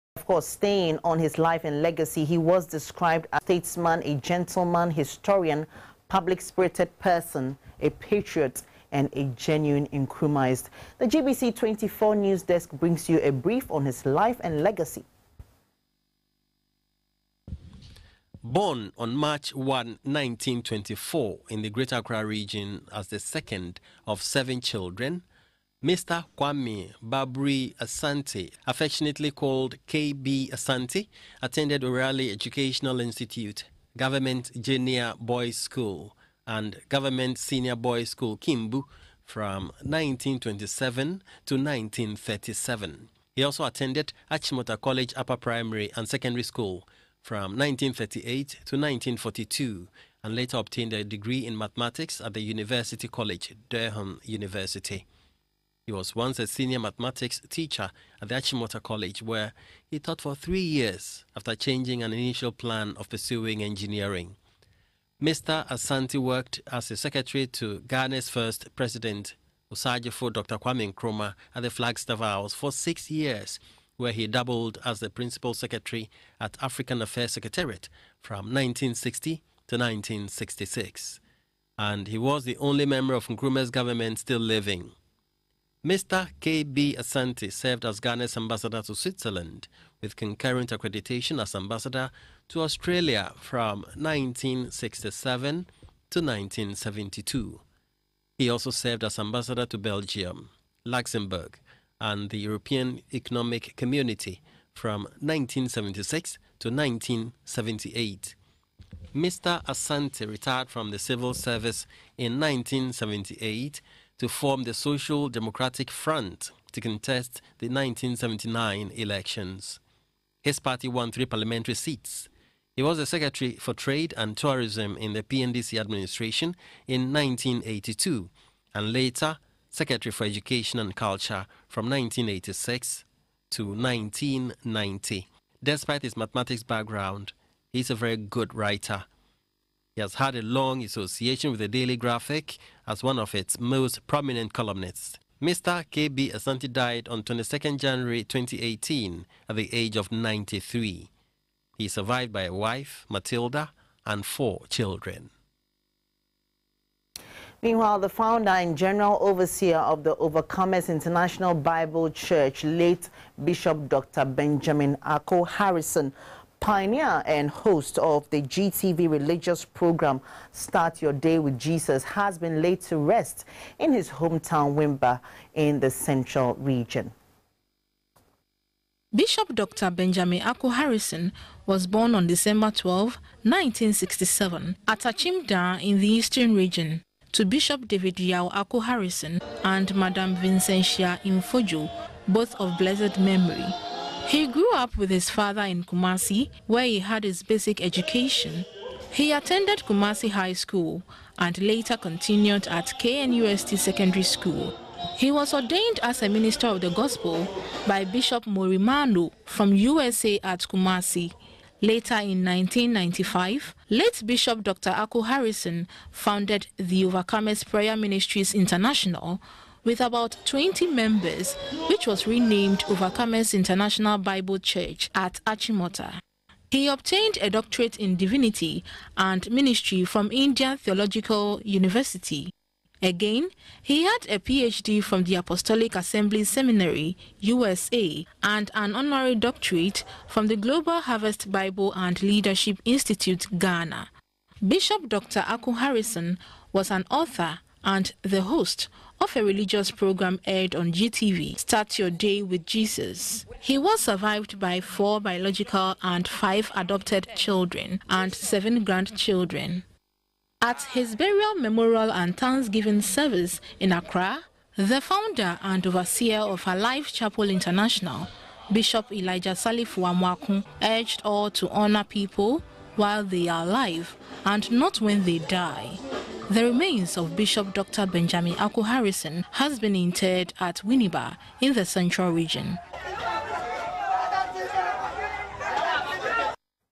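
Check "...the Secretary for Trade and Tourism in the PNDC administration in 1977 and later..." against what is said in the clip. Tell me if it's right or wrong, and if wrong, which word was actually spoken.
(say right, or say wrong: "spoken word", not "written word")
wrong: "1982", not "1977".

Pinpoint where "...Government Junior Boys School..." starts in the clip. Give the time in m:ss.
0:33.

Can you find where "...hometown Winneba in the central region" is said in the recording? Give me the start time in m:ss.
2:54.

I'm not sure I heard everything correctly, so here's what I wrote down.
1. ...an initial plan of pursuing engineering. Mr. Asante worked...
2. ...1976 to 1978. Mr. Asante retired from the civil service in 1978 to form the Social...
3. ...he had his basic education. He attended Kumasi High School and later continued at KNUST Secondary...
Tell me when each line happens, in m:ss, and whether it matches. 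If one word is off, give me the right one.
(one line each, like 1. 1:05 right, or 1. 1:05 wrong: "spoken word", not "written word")
1. 1:02 right
2. 1:45 right
3. 3:16 right.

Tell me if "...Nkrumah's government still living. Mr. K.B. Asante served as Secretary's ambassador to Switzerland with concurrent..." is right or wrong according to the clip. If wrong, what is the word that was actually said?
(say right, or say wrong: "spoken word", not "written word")
wrong: "Ghana", not "Secretary".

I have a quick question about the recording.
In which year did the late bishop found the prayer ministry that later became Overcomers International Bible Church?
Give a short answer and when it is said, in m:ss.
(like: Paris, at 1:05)
1995, at 3:32.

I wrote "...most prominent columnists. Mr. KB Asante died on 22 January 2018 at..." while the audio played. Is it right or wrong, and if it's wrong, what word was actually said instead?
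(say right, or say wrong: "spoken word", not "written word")
right.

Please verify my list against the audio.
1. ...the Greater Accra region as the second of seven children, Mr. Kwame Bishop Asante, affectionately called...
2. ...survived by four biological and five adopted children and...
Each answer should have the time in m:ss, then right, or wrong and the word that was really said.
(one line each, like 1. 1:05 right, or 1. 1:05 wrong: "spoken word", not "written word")
1. 0:21 wrong: "Babri", not "Bishop"
2. 4:14 right.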